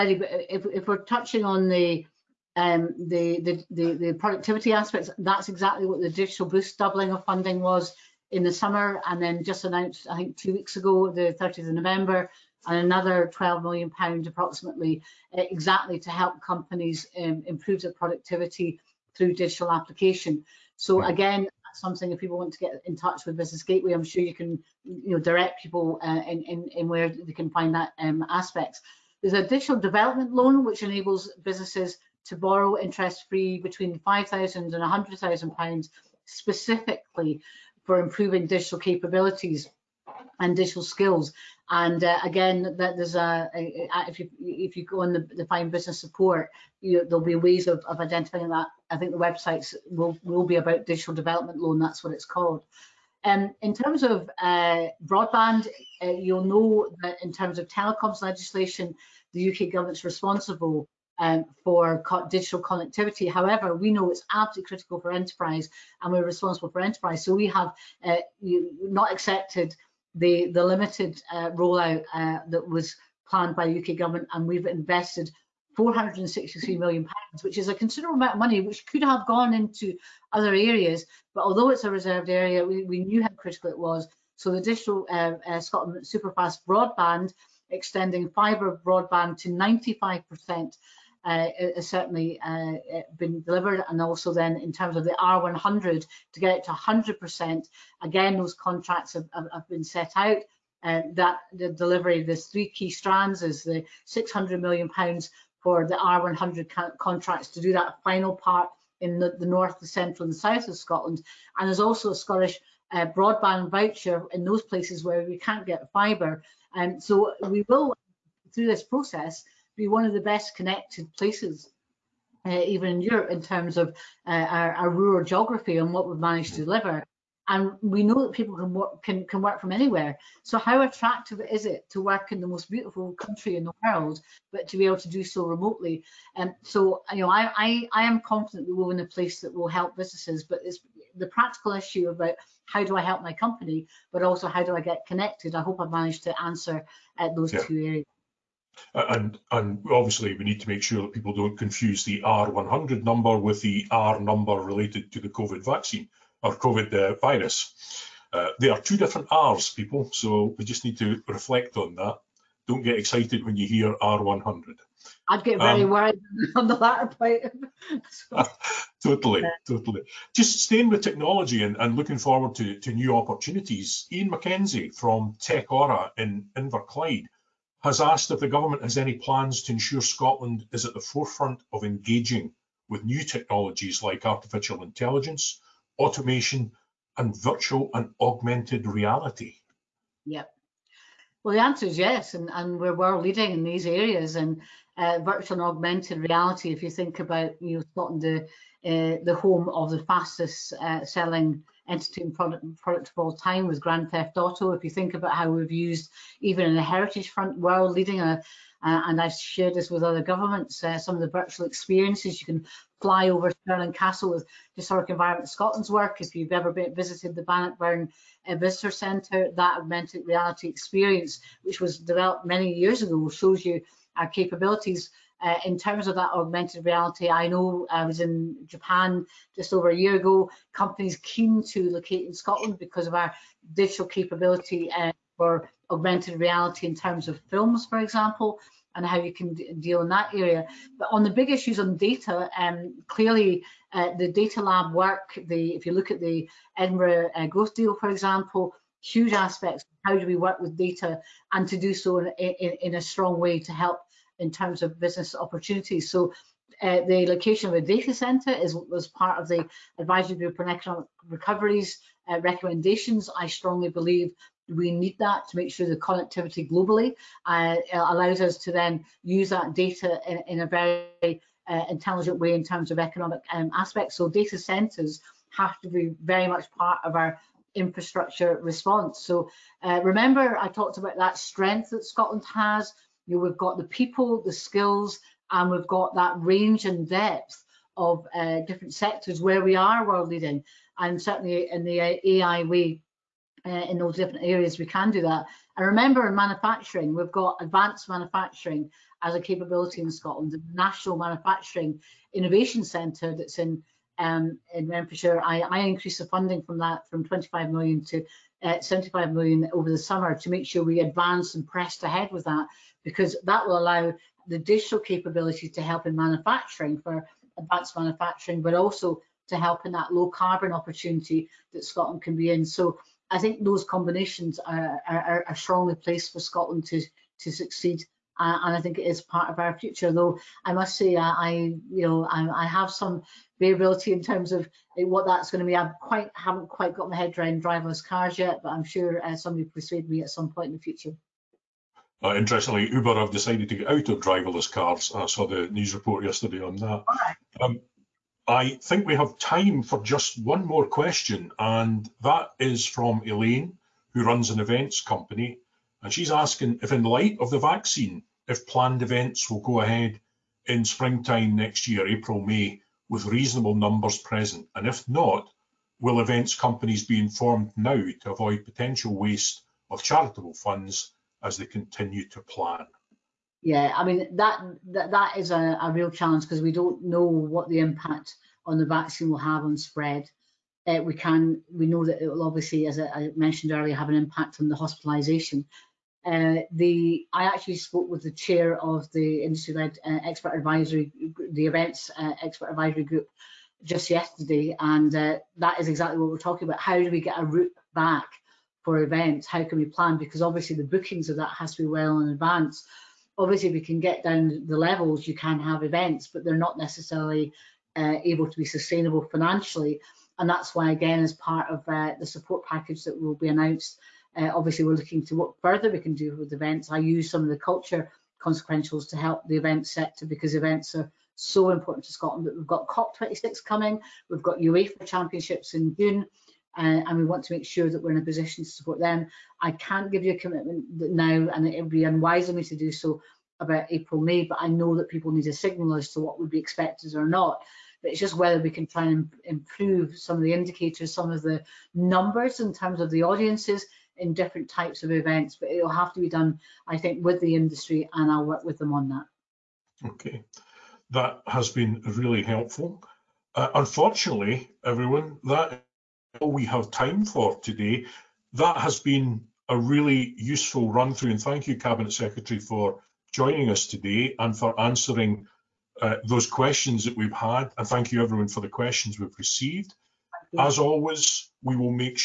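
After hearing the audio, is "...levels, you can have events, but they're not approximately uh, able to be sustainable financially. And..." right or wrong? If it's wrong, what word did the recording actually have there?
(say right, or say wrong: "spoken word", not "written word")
wrong: "necessarily", not "approximately".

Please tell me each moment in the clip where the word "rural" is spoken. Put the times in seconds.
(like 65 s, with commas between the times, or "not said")
124 s.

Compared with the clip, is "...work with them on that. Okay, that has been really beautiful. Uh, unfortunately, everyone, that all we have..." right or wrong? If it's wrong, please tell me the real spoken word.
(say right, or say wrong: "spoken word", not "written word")
wrong: "helpful", not "beautiful".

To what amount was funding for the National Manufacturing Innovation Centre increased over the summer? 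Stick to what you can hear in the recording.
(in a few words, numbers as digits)
75 million.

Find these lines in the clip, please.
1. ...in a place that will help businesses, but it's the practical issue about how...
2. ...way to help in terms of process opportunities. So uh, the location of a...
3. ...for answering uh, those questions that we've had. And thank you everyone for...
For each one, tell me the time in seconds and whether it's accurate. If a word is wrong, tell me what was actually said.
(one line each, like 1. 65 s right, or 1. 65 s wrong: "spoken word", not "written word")
1. 138 s right
2. 253 s wrong: "business", not "process"
3. 464 s right.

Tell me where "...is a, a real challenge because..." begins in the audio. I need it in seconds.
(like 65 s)
375 s.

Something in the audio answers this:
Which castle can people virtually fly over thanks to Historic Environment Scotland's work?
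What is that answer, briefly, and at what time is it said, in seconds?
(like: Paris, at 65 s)
Stirling Castle, at 213 s.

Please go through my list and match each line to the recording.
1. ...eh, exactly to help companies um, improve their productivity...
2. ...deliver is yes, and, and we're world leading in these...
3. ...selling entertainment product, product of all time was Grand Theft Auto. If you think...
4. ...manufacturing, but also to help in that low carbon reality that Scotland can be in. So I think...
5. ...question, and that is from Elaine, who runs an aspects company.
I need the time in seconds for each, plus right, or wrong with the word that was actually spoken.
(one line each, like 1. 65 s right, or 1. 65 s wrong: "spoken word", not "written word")
1. 15 s right
2. 191 s wrong: "answer", not "deliver"
3. 201 s right
4. 317 s wrong: "opportunity", not "reality"
5. 350 s wrong: "events", not "aspects".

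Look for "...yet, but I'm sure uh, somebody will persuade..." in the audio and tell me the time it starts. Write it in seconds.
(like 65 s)
338 s.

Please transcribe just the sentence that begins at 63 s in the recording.
However, we know it's absolutely critical for enterprise, and we're responsible for enterprise.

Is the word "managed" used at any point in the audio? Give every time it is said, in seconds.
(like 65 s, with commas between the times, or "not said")
126 s, 145 s.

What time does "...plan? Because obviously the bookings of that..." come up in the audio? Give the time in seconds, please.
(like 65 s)
399 s.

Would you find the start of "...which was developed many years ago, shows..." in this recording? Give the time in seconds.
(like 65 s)
221 s.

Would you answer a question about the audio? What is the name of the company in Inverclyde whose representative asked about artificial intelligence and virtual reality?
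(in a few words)
TechAura.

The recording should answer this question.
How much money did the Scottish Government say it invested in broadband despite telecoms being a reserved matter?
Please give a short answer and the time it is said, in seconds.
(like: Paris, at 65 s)
463 million pounds, at 75 s.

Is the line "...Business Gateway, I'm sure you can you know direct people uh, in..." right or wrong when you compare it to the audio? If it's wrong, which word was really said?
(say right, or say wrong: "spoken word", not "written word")
right.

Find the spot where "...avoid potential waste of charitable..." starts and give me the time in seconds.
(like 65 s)
368 s.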